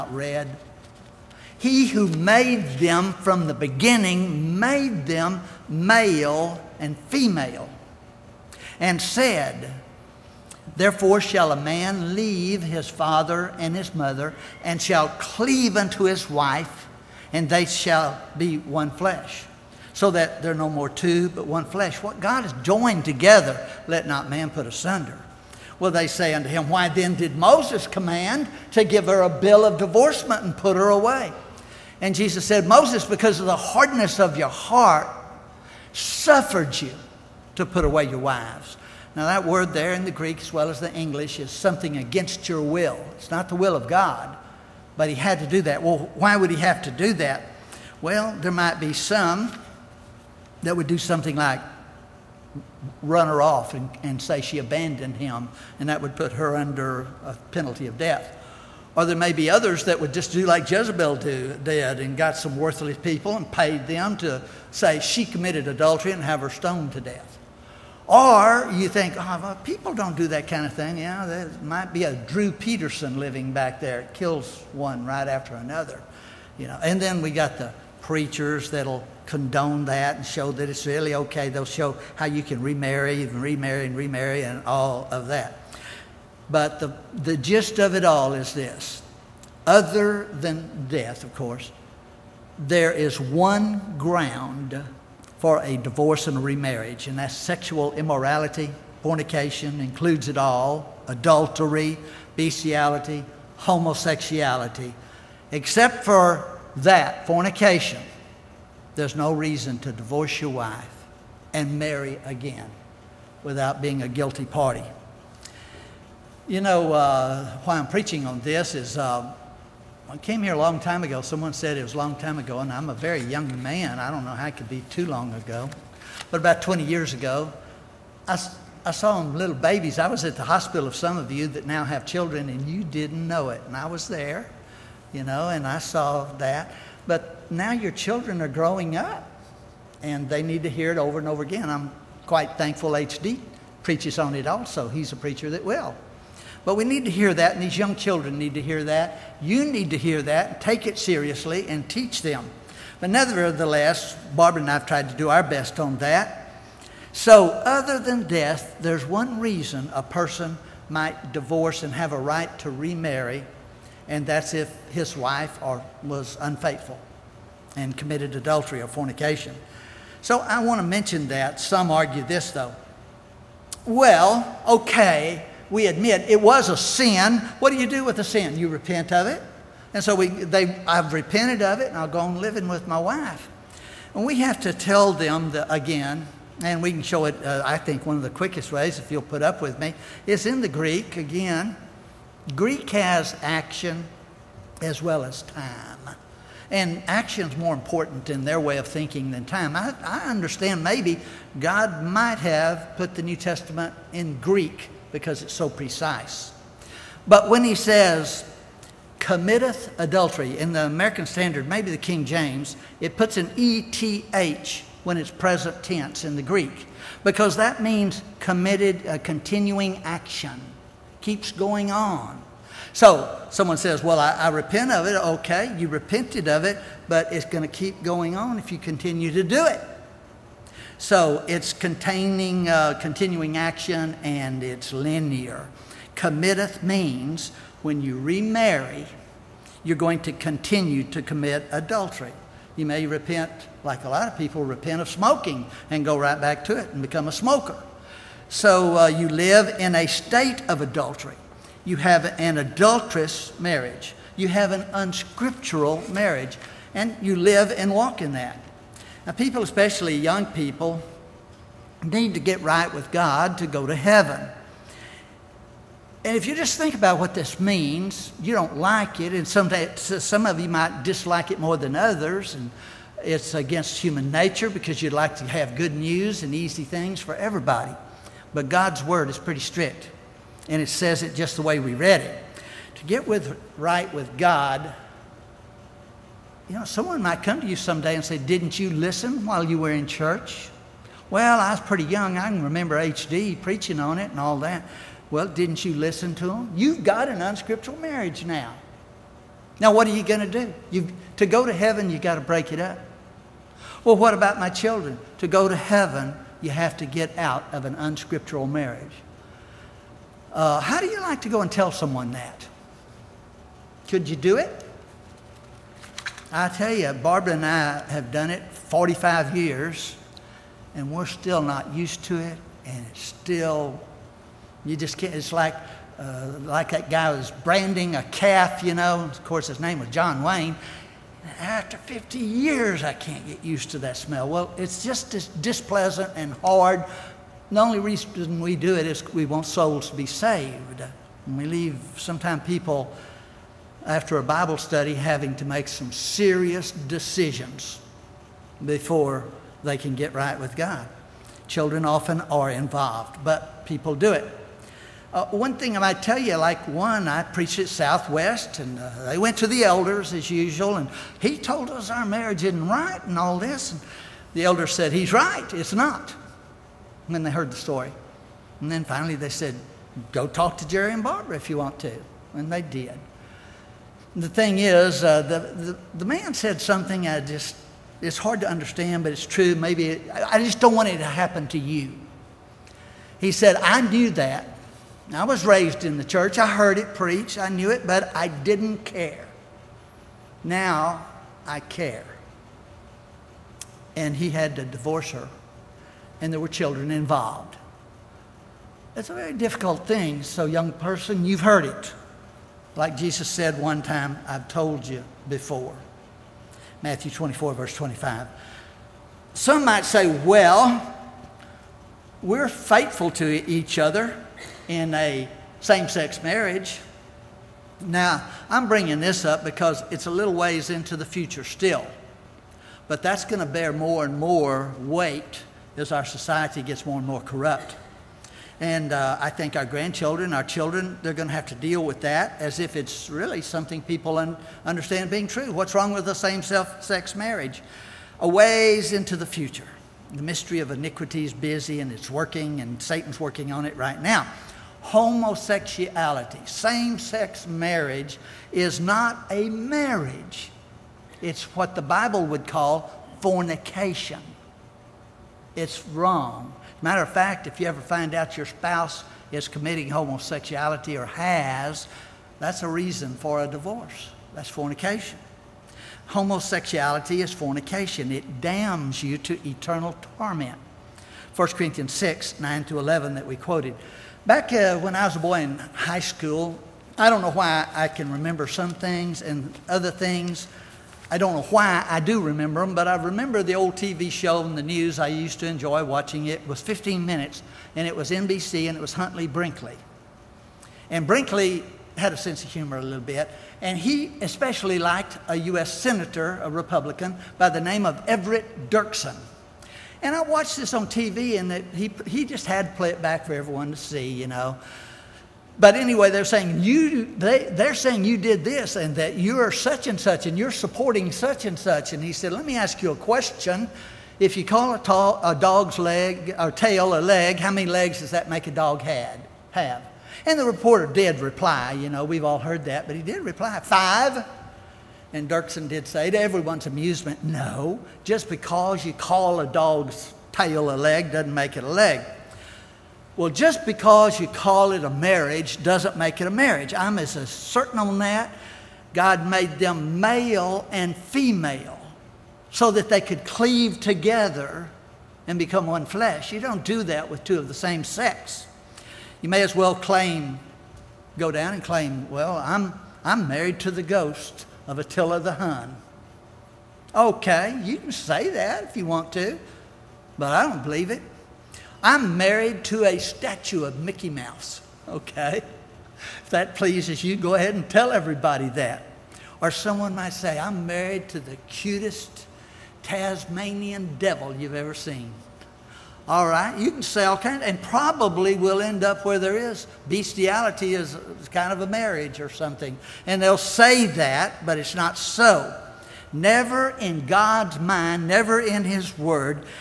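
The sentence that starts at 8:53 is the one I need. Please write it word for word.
Well, just because you call it a marriage doesn't make it a marriage.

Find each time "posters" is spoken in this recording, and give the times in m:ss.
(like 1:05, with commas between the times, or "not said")
not said.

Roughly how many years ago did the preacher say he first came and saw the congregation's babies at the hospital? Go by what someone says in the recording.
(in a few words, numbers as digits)
20.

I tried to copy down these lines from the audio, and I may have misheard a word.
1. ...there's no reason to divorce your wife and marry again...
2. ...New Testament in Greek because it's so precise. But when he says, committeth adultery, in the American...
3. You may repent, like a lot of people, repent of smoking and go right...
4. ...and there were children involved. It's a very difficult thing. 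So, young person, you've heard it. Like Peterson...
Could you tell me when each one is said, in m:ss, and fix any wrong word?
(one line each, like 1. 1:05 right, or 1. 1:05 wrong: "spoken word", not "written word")
1. 1:48 right
2. 3:23 right
3. 4:02 right
4. 6:36 wrong: "Jesus", not "Peterson".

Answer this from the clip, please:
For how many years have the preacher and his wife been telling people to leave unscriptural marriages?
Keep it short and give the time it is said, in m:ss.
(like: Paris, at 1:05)
45, at 5:18.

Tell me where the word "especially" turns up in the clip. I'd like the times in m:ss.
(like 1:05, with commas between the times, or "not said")
4:19, 8:14.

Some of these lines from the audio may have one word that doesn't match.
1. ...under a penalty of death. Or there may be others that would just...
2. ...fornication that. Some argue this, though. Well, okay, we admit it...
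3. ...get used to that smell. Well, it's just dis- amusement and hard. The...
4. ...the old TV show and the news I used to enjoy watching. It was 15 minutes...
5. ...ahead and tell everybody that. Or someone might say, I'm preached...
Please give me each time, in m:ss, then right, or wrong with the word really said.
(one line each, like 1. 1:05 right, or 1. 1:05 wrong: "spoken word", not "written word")
1. 0:56 right
2. 2:50 wrong: "mention", not "fornication"
3. 5:33 wrong: "displeasant", not "amusement"
4. 8:03 right
5. 9:27 wrong: "married", not "preached".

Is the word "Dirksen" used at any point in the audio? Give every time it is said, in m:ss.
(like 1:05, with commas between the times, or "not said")
8:18, 8:45.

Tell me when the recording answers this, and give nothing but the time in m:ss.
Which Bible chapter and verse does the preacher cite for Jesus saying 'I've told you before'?
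6:47.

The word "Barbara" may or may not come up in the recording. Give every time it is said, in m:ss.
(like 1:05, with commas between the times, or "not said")
2:34, 5:17, 6:11.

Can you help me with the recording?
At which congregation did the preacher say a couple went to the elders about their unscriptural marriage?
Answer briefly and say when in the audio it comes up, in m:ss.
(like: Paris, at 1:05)
Southwest, at 5:57.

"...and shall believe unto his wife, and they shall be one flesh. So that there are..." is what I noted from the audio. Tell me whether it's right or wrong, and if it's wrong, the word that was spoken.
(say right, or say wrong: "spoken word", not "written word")
wrong: "cleave", not "believe".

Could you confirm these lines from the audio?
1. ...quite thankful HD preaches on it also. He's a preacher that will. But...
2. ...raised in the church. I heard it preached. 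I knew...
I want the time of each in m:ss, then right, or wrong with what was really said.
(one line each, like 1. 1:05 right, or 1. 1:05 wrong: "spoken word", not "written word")
1. 2:22 right
2. 6:25 right.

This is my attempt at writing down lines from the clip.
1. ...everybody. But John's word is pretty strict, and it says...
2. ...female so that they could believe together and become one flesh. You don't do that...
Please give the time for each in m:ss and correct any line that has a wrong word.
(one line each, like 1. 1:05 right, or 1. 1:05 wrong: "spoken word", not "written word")
1. 4:37 wrong: "God", not "John"
2. 9:01 wrong: "cleave", not "believe".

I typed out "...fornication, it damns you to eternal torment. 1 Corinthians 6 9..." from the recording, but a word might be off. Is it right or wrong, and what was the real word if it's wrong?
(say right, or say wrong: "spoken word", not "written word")
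right.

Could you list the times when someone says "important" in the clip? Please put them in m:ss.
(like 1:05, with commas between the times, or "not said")
3:17.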